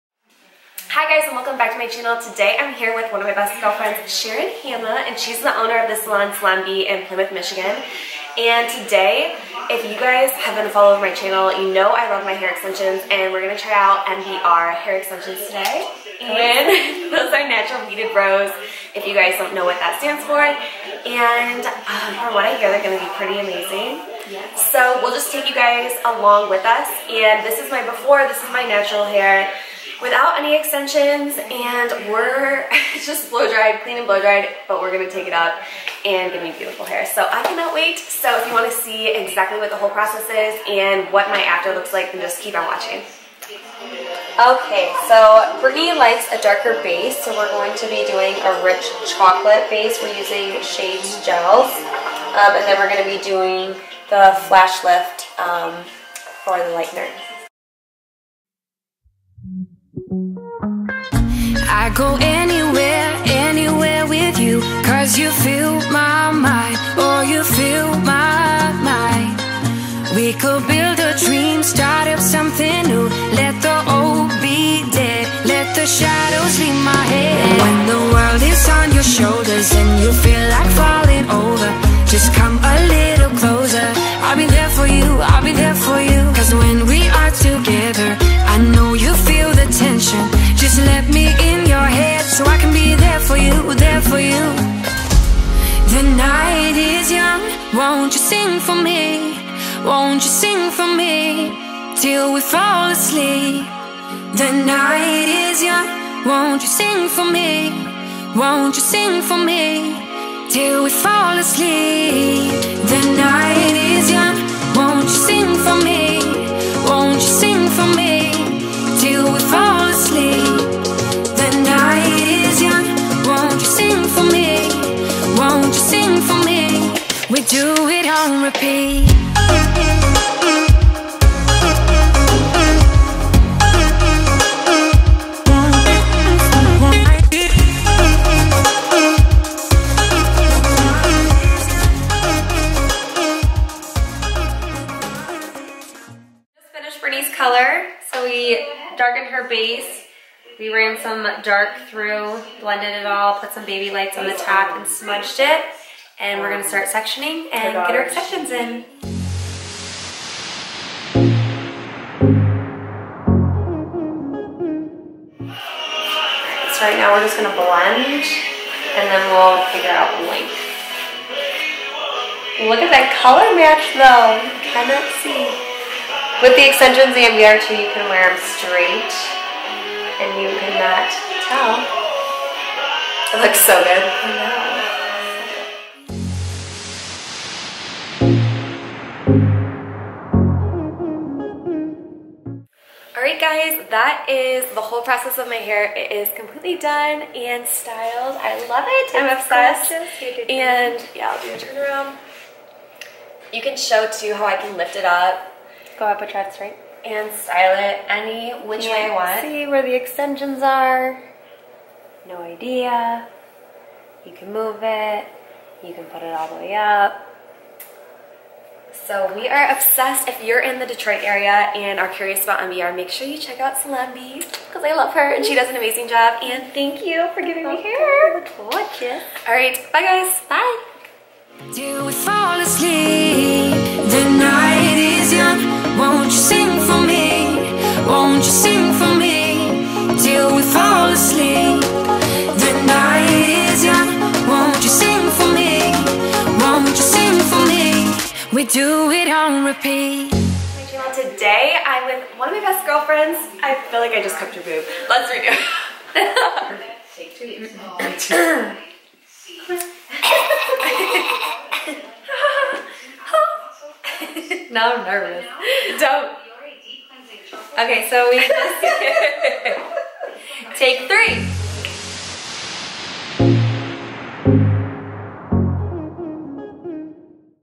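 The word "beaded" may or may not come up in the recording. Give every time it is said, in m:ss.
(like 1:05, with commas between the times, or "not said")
0:17.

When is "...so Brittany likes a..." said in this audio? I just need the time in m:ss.
0:45.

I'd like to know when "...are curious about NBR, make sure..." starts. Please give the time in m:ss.
3:41.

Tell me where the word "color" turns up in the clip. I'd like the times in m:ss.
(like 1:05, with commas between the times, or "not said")
2:27, 2:53.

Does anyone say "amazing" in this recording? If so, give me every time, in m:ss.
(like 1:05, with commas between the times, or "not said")
0:23, 3:45.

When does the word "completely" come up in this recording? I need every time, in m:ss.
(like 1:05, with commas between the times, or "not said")
3:16.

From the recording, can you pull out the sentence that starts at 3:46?
And thank you for giving me hair.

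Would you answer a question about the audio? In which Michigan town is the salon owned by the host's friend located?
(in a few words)
Plymouth.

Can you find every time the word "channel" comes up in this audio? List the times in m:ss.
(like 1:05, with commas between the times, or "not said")
0:01, 0:11.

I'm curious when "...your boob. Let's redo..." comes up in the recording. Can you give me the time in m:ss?
4:14.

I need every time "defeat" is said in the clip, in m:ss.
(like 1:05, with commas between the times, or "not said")
not said.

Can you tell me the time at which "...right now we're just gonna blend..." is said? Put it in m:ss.
2:46.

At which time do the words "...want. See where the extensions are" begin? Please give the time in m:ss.
3:29.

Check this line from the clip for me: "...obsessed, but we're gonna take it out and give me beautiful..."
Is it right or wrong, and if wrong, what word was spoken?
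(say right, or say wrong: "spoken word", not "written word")
wrong: "dried", not "obsessed".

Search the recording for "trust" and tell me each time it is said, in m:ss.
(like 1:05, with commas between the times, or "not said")
3:26.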